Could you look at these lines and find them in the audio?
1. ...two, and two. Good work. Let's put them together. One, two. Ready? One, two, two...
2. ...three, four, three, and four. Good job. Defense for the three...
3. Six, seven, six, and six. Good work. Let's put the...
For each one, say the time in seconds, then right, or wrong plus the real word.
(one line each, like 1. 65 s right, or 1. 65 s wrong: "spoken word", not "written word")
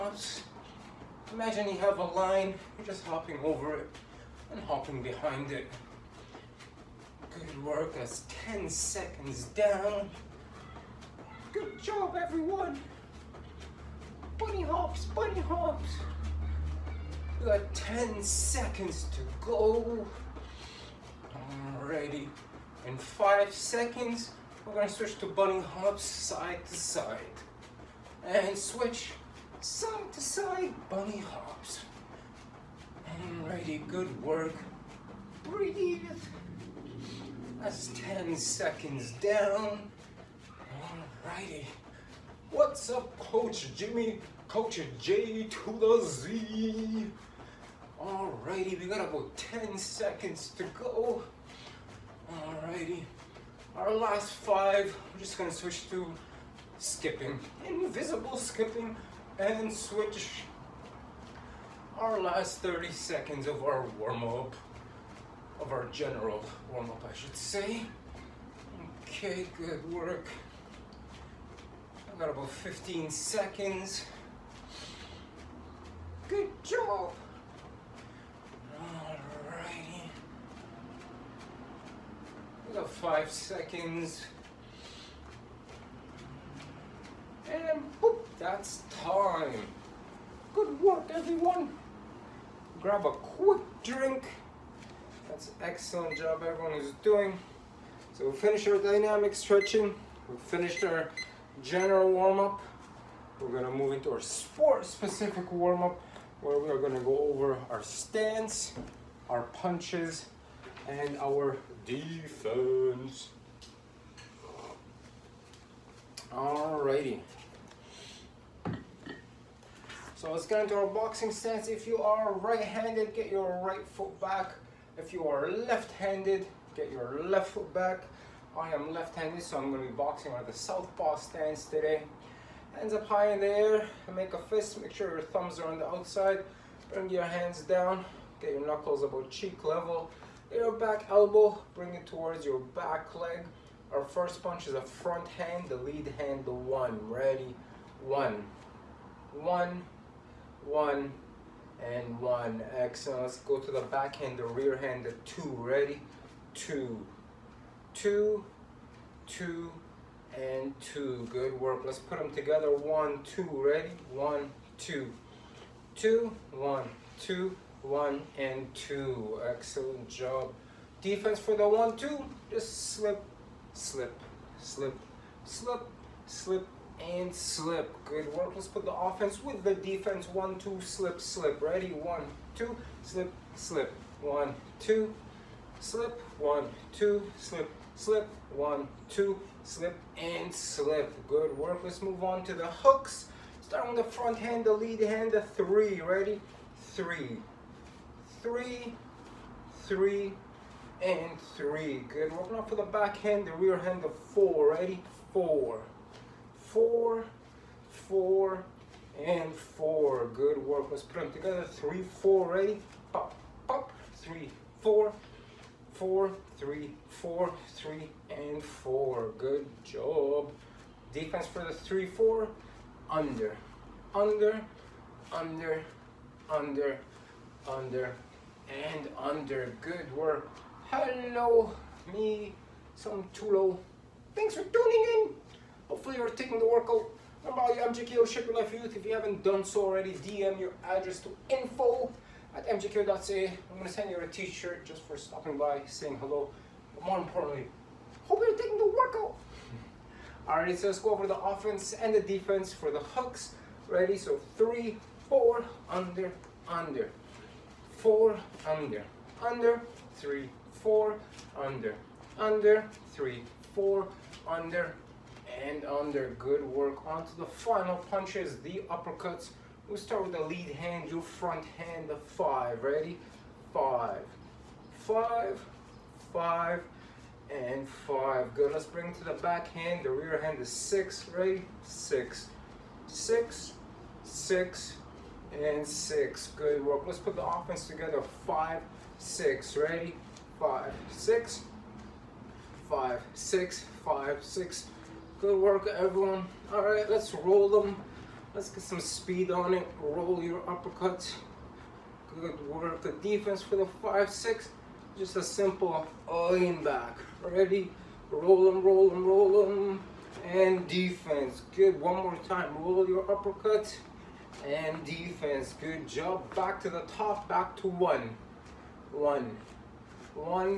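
1. 159 s right
2. 216 s right
3. 281 s wrong: "six", not "seven".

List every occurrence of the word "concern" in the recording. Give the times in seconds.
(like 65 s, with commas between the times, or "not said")
not said.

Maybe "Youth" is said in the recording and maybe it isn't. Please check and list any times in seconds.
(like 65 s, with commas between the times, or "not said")
238 s.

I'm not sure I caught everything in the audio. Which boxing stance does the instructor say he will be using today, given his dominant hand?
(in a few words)
Southpaw.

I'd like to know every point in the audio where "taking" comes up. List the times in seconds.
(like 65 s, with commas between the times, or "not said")
236 s, 248 s.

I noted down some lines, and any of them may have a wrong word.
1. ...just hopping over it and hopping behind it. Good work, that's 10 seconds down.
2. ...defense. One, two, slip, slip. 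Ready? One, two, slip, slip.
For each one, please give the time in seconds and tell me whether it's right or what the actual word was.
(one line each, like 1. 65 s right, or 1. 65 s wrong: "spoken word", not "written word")
1. 2 s right
2. 179 s right.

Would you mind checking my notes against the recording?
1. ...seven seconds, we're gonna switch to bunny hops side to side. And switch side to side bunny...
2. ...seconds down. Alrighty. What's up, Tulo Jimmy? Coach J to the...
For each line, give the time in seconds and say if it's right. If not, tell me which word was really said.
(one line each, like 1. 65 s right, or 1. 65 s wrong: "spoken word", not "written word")
1. 22 s wrong: "five", not "seven"
2. 38 s wrong: "Coach", not "Tulo".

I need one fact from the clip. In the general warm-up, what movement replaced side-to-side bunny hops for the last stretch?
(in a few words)
Invisible skipping.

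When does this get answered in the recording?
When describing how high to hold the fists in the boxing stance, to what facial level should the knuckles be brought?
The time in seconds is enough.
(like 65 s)
139 s.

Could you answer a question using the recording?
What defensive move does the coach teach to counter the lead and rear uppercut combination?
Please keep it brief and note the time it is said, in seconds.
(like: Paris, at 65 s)
Lean back, at 306 s.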